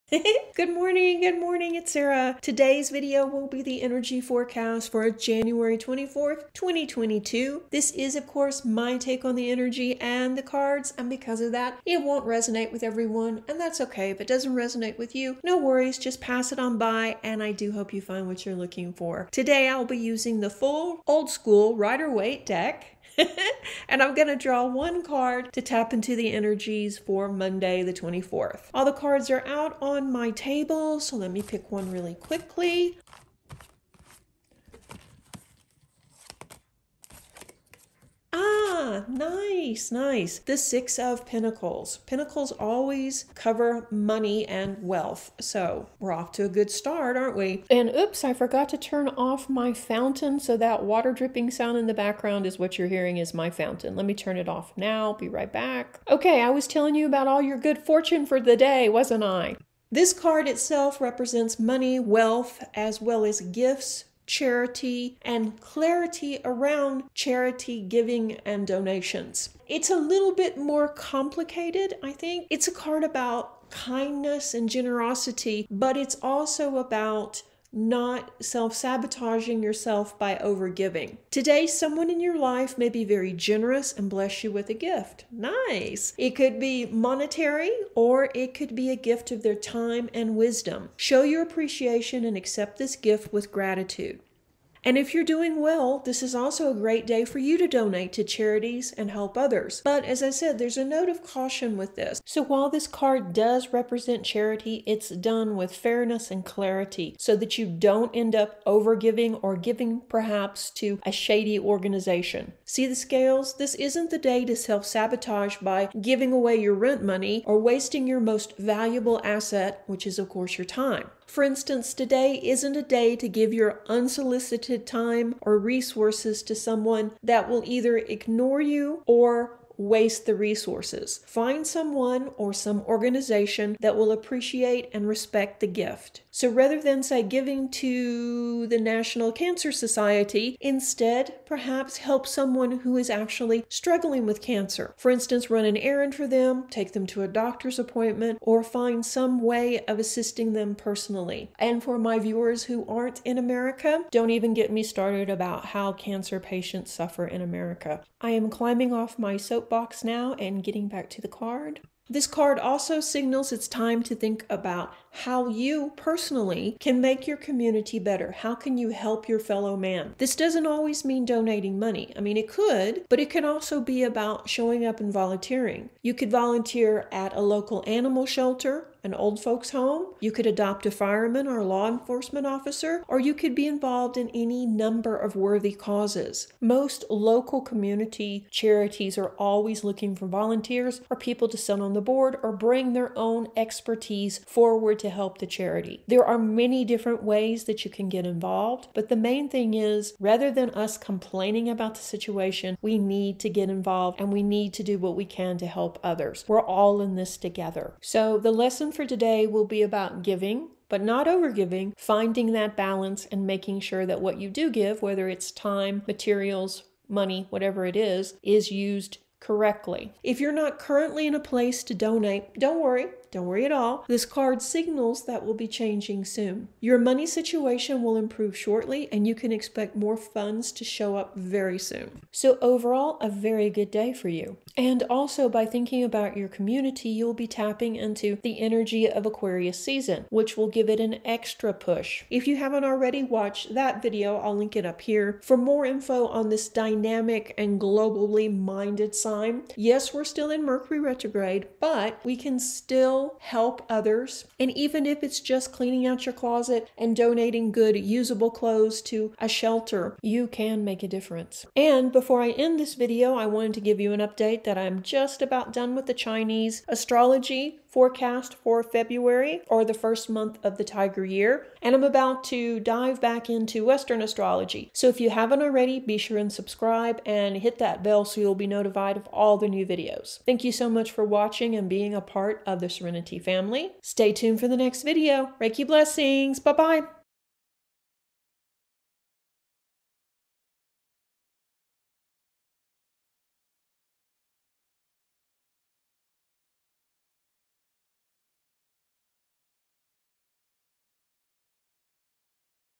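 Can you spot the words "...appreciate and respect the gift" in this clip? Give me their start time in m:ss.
2:14.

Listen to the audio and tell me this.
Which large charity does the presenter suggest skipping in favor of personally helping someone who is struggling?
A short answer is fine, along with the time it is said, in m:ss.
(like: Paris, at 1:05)
National Cancer Society, at 2:18.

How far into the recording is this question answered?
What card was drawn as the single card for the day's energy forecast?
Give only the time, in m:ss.
0:40.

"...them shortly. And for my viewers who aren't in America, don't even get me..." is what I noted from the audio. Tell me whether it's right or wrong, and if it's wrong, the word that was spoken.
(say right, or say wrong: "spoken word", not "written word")
wrong: "personally", not "shortly".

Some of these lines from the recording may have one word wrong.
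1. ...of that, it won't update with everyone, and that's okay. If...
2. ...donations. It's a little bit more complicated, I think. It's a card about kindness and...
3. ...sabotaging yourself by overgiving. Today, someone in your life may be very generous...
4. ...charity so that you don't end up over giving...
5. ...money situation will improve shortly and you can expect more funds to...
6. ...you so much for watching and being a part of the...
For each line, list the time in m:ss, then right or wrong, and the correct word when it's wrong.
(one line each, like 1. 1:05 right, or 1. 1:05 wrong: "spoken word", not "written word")
1. 0:11 wrong: "resonate", not "update"
2. 1:08 right
3. 1:18 right
4. 1:46 wrong: "clarity", not "charity"
5. 3:46 right
6. 4:40 right.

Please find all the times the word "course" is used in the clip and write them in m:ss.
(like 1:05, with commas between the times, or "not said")
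0:08, 2:00.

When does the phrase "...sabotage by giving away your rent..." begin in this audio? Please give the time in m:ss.
1:54.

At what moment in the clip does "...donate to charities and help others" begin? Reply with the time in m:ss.
1:37.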